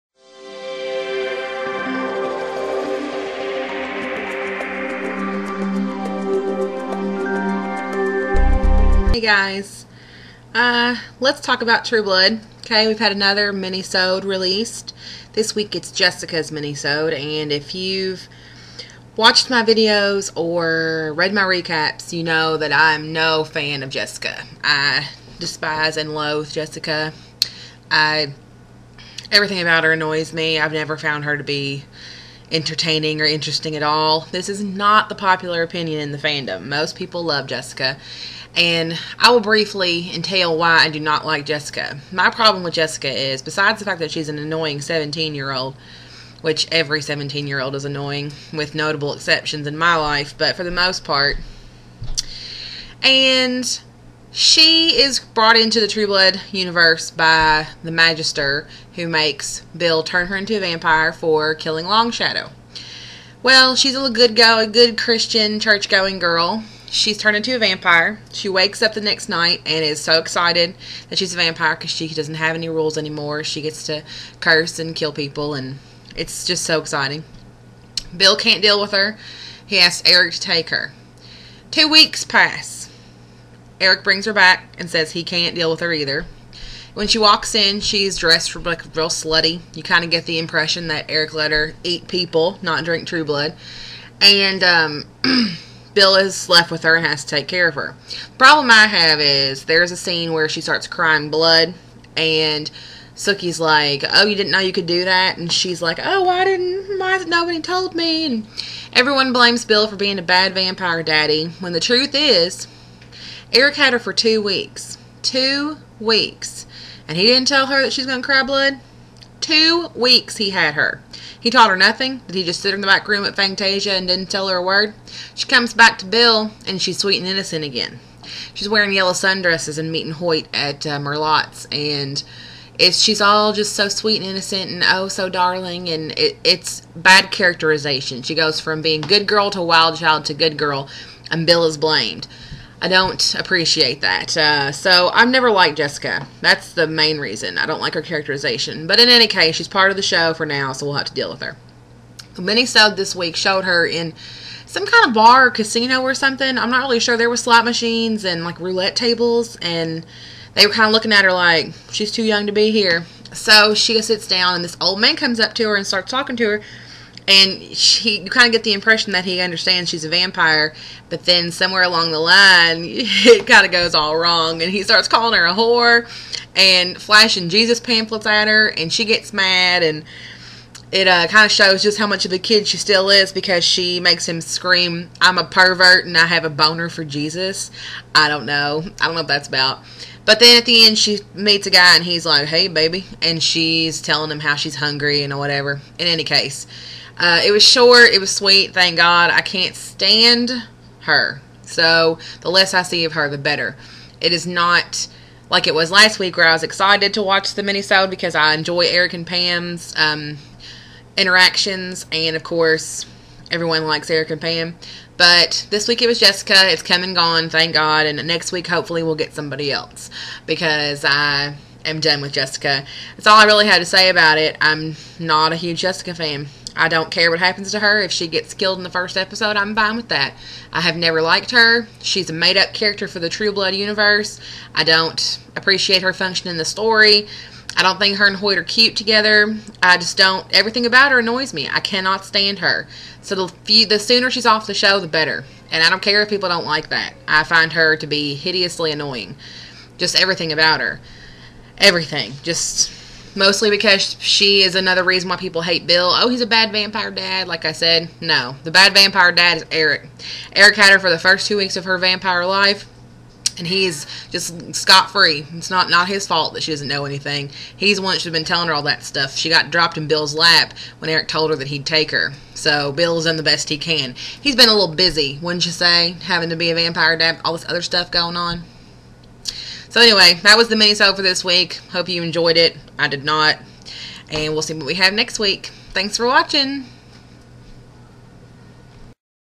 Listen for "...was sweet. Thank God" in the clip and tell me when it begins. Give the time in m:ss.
3:18.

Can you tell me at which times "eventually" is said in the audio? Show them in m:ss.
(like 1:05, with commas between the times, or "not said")
not said.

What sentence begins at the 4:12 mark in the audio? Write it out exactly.
Just mostly because she is another reason why people hate Bill.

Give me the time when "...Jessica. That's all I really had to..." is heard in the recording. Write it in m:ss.
3:42.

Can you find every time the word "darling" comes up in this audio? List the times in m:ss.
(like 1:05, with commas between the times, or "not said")
2:15.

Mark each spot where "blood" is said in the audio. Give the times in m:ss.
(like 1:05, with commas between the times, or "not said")
0:12, 0:56, 1:33, 1:41, 1:58, 3:53.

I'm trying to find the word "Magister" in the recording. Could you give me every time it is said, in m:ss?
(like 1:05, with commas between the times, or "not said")
0:57.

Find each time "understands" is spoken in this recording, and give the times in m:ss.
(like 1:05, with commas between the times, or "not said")
2:49.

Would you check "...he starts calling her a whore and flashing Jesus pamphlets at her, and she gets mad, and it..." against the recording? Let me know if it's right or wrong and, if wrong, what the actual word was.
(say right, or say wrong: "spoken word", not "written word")
right.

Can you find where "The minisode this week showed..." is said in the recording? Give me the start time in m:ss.
2:32.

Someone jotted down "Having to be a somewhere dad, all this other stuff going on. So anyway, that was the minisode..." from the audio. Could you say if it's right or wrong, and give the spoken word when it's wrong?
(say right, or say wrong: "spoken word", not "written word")
wrong: "vampire", not "somewhere".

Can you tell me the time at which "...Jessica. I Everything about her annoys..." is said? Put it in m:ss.
0:26.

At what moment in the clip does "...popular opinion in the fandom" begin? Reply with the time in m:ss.
0:35.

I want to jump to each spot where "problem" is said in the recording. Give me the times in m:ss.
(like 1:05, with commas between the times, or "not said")
0:42, 1:38.